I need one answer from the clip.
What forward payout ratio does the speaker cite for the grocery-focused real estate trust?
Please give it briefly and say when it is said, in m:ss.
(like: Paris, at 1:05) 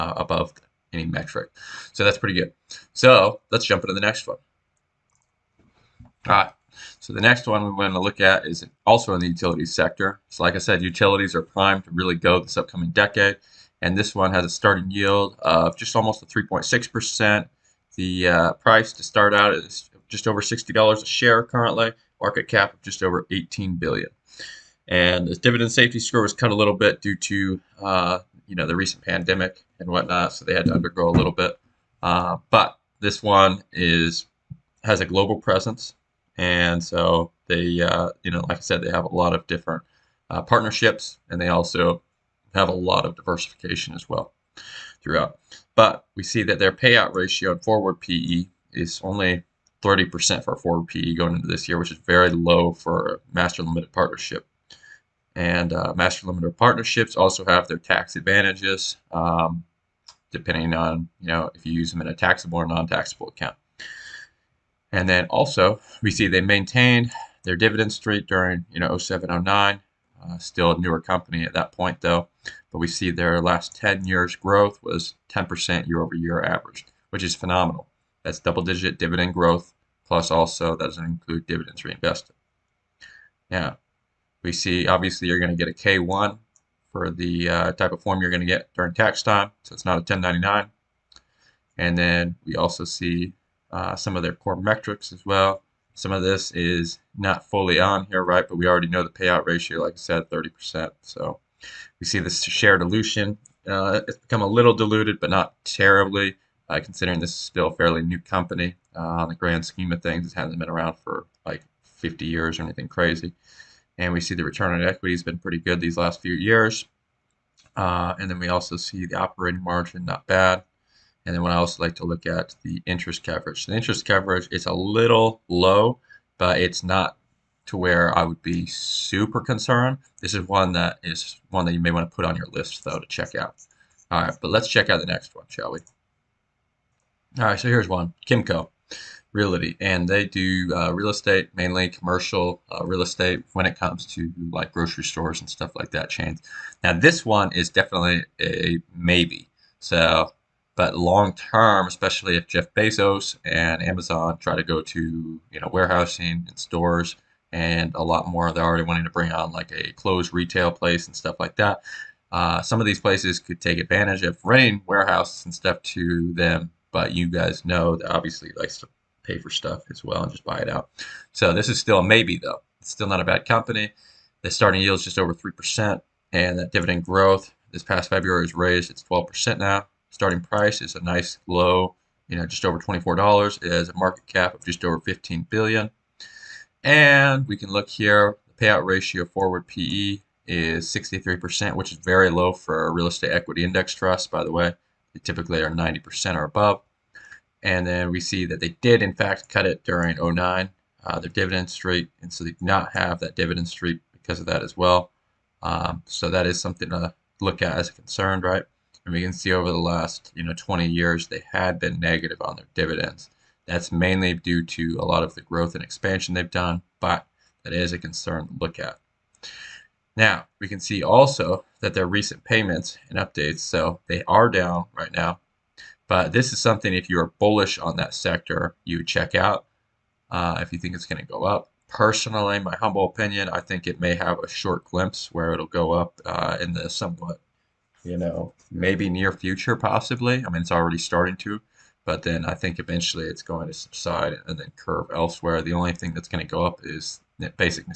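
63%, at 3:10.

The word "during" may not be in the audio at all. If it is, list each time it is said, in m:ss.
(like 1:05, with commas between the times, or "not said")
1:08, 1:28, 3:19.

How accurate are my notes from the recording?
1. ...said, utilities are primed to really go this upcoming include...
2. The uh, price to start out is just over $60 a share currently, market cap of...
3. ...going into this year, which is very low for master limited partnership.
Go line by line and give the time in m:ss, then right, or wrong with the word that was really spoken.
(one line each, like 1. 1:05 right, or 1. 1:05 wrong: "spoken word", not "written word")
1. 0:10 wrong: "decade", not "include"
2. 0:17 right
3. 0:51 right.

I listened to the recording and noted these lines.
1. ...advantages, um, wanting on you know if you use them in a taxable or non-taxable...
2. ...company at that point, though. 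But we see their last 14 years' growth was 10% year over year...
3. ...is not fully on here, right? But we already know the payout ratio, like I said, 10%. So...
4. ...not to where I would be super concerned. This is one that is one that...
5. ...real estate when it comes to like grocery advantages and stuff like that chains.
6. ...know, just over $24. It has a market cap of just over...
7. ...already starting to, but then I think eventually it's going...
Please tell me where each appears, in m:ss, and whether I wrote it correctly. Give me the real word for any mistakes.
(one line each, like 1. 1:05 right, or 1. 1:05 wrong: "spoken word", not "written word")
1. 0:58 wrong: "depending", not "wanting"
2. 1:10 wrong: "10", not "14"
3. 1:36 wrong: "30", not "10"
4. 2:06 right
5. 2:22 wrong: "stores", not "advantages"
6. 3:02 right
7. 4:00 right.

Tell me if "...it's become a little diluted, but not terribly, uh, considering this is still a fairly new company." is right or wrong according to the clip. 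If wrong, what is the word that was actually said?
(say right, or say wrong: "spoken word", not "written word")
right.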